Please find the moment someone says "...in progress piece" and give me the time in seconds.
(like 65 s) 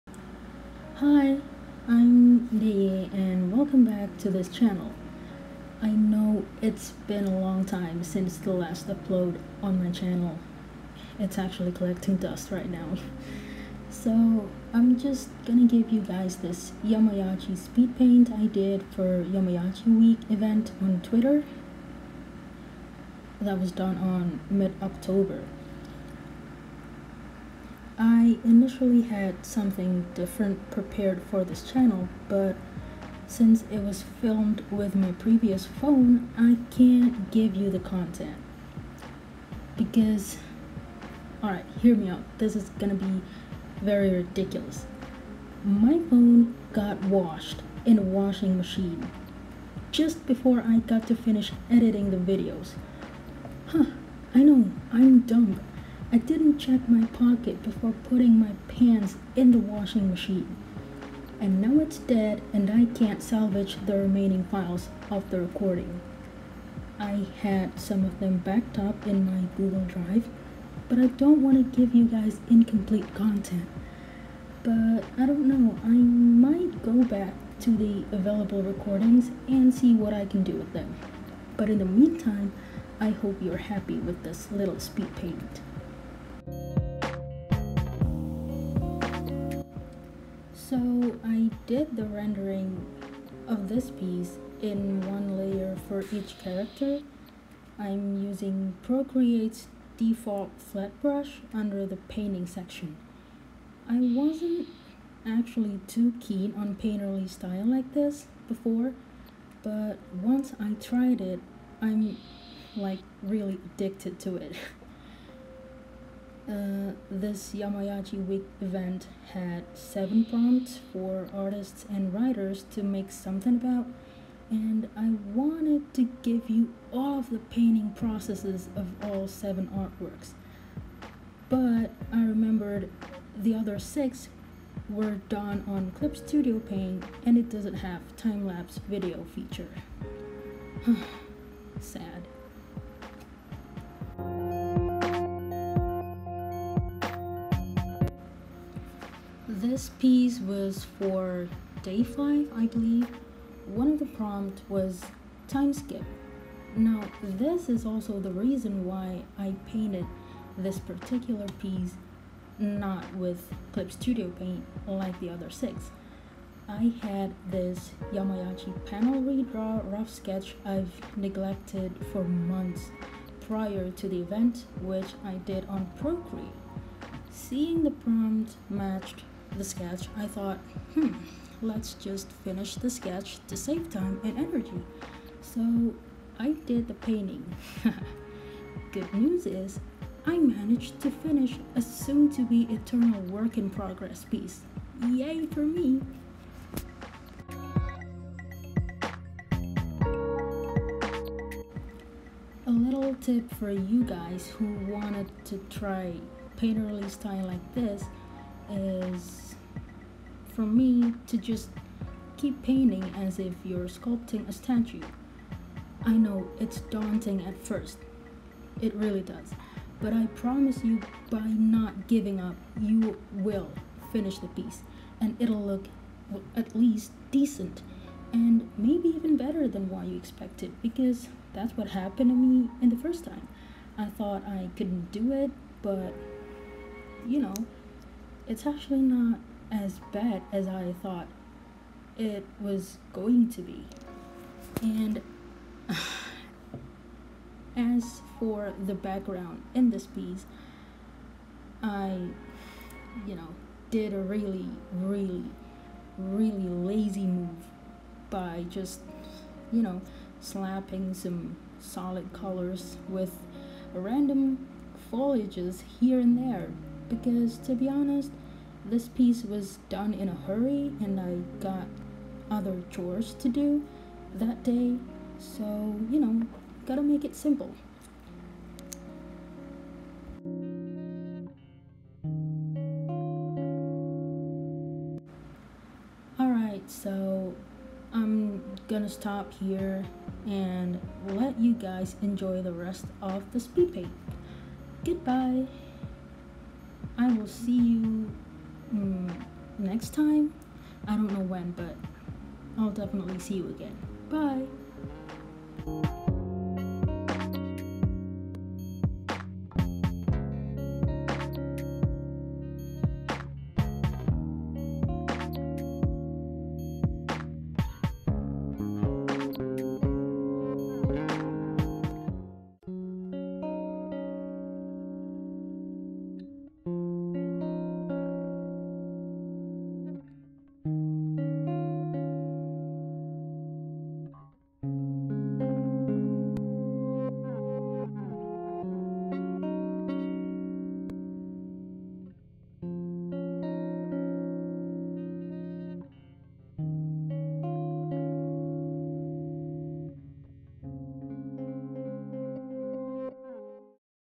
193 s.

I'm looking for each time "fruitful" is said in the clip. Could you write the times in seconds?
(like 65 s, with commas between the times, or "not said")
not said.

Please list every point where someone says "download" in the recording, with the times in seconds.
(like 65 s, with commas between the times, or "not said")
not said.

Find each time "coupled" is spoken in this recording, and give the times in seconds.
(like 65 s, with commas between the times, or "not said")
not said.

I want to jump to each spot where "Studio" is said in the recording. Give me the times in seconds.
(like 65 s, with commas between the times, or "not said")
136 s, 163 s.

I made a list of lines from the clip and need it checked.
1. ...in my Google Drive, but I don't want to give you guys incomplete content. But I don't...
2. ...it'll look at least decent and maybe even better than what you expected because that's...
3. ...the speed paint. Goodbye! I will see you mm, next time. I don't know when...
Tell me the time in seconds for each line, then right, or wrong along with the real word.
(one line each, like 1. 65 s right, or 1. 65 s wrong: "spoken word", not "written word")
1. 69 s right
2. 225 s right
3. 293 s right.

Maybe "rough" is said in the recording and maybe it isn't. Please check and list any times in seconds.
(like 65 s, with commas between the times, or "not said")
169 s.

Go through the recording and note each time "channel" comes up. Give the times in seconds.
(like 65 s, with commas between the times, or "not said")
4 s, 9 s, 31 s.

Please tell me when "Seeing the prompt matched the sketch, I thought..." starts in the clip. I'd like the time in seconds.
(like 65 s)
177 s.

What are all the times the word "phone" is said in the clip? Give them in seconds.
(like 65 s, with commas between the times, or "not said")
35 s, 46 s.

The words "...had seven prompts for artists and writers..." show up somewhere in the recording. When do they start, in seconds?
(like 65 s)
119 s.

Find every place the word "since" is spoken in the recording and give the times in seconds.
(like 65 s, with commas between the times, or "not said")
8 s, 33 s.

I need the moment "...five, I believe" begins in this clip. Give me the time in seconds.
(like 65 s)
152 s.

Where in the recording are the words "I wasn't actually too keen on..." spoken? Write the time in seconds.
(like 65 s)
103 s.